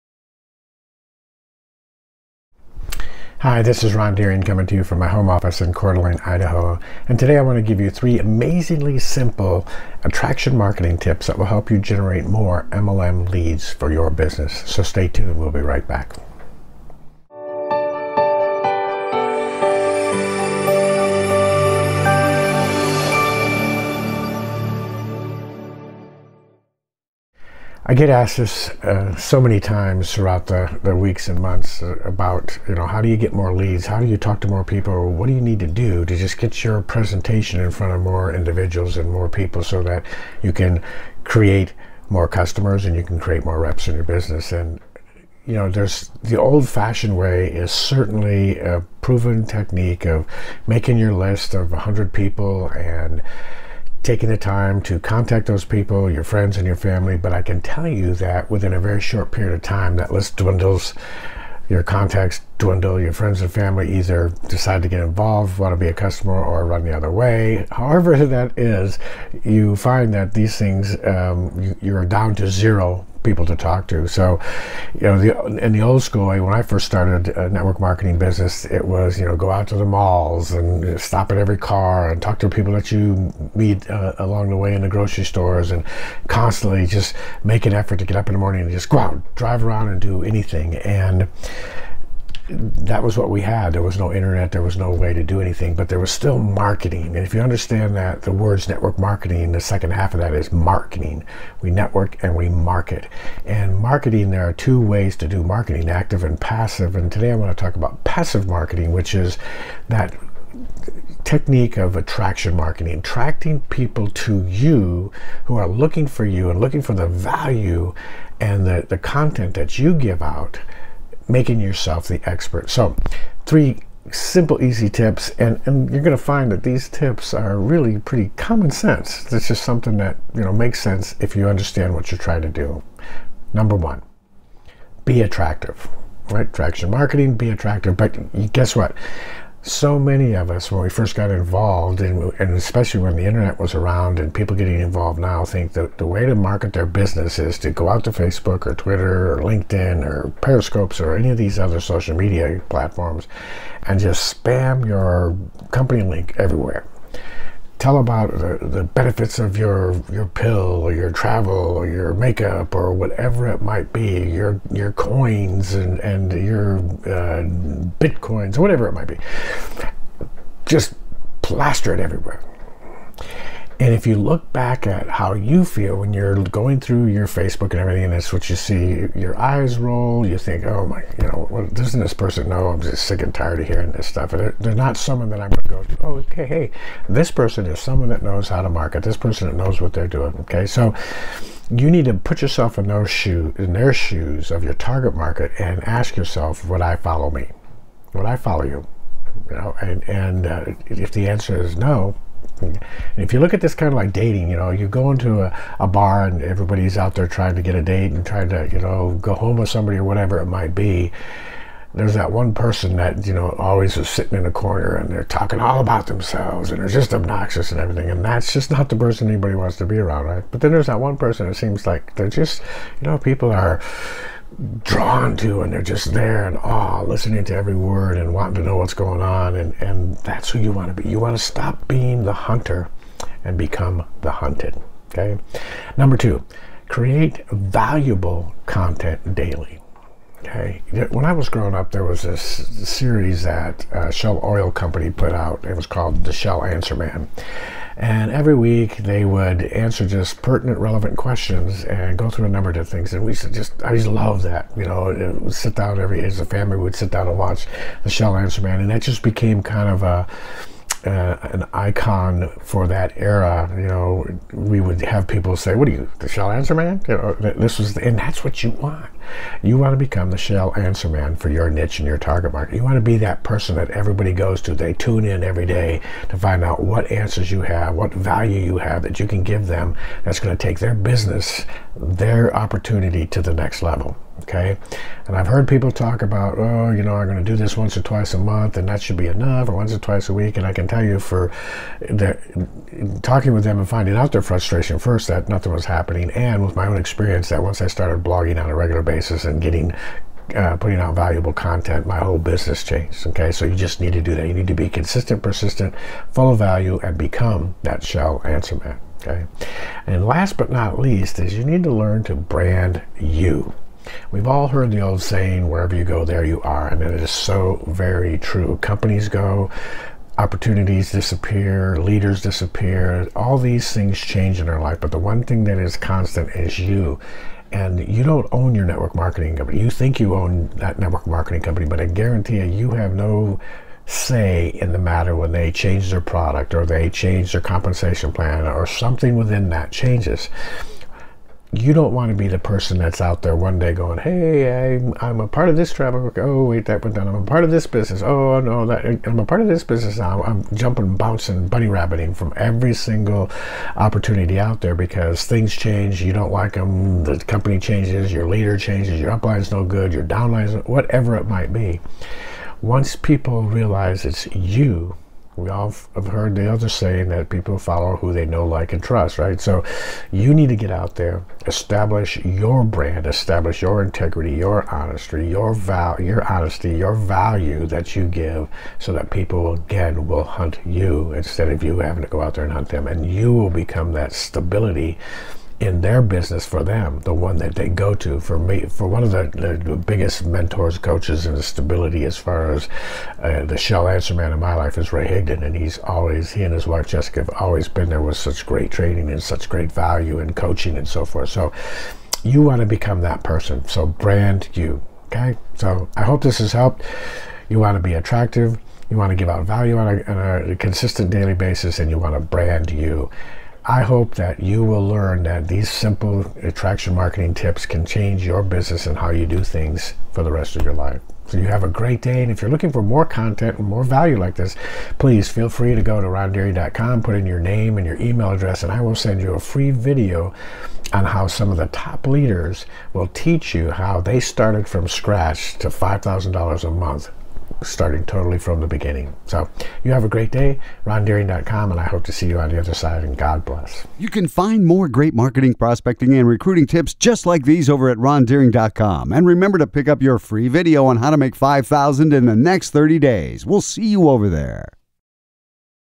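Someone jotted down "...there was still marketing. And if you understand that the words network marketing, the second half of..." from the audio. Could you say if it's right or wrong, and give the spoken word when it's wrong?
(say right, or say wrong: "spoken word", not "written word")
right.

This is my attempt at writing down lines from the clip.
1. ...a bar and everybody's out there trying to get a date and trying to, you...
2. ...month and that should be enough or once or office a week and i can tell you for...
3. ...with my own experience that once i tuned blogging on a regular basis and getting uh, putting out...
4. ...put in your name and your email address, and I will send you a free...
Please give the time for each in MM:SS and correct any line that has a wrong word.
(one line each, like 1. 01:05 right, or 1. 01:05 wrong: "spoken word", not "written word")
1. 03:25 right
2. 04:48 wrong: "twice", not "office"
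3. 04:56 wrong: "started", not "tuned"
4. 07:07 right.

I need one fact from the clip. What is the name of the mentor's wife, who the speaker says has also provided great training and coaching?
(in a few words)
Jessica.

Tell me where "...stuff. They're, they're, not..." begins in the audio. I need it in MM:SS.
03:04.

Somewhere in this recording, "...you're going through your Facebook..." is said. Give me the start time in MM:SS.
02:56.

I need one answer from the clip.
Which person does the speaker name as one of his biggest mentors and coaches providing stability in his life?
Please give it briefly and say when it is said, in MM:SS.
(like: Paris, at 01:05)
Ray Higdon, at 06:35.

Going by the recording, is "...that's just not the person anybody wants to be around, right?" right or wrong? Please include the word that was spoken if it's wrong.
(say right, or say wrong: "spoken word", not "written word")
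right.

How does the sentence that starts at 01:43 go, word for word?
And marketing, there are two ways to do marketing active and passive.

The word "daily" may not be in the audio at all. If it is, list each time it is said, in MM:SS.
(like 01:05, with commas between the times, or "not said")
03:59, 06:51.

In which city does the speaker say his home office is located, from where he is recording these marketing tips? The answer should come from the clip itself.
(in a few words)
Coeur d'Alene.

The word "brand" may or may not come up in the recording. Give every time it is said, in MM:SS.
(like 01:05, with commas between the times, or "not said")
05:12, 06:12, 06:44, 06:52.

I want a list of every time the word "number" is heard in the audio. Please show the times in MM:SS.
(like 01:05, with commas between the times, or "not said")
02:13, 03:55, 04:12.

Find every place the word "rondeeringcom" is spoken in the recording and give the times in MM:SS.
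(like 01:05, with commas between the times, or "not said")
07:06, 07:21, 07:28.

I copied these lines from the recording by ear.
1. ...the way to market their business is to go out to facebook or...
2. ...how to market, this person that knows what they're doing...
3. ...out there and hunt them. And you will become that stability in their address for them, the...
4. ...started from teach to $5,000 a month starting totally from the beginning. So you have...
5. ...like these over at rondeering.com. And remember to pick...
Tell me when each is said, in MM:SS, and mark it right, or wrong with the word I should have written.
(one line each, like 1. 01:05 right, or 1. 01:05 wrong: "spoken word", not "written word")
1. 02:25 right
2. 03:08 right
3. 06:22 wrong: "business", not "address"
4. 07:14 wrong: "scratch", not "teach"
5. 07:27 right.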